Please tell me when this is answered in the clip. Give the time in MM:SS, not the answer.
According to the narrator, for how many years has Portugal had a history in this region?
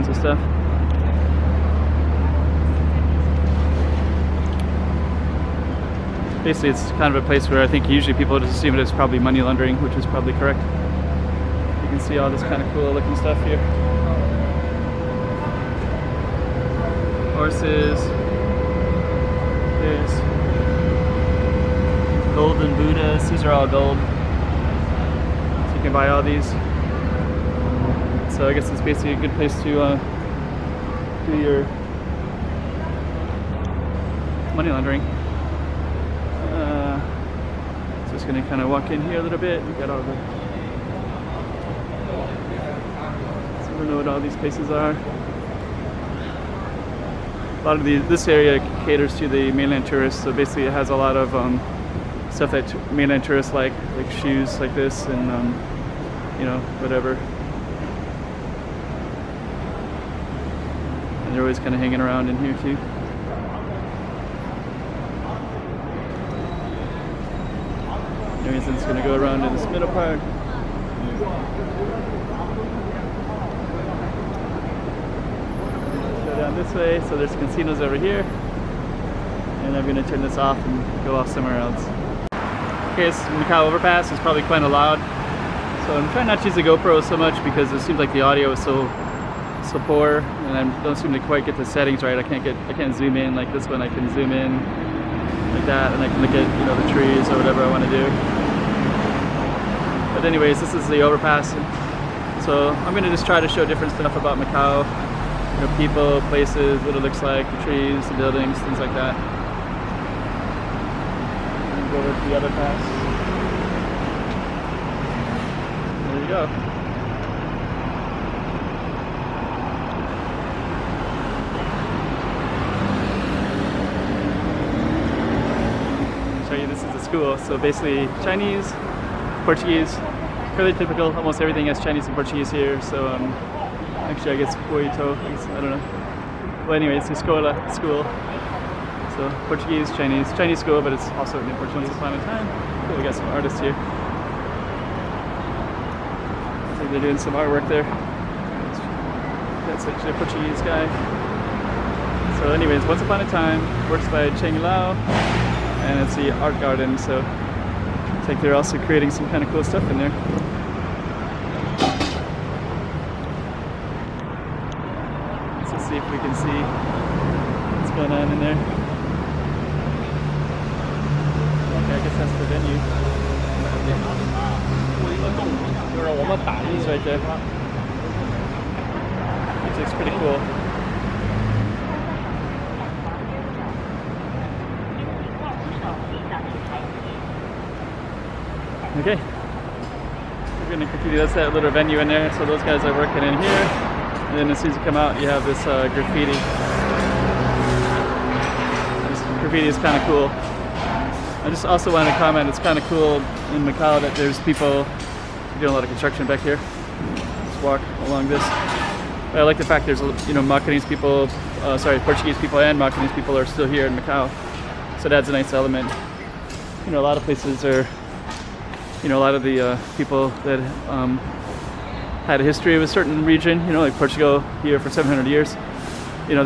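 03:44.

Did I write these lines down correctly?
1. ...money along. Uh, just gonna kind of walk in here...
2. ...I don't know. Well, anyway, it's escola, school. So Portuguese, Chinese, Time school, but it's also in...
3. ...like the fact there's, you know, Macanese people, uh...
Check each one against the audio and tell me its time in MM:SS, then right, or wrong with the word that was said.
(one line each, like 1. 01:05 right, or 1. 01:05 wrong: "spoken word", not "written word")
1. 00:34 wrong: "laundering", not "along"
2. 02:15 wrong: "Chinese", not "Time"
3. 03:29 right.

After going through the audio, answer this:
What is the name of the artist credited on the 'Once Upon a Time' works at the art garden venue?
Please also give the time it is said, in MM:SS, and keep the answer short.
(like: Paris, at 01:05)
Cheng Lao, at 02:34.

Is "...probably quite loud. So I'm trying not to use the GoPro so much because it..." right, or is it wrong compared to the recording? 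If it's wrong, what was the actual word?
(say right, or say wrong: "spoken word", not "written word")
right.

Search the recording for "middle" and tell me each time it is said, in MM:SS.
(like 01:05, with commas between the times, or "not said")
01:09.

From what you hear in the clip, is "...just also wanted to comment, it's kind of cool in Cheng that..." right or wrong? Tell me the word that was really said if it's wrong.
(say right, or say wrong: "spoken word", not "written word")
wrong: "Macau", not "Cheng".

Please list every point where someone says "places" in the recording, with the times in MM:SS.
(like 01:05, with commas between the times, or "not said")
00:07, 00:29, 00:44, 01:46, 03:37.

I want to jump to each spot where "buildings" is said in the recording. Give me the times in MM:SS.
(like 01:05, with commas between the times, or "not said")
01:48.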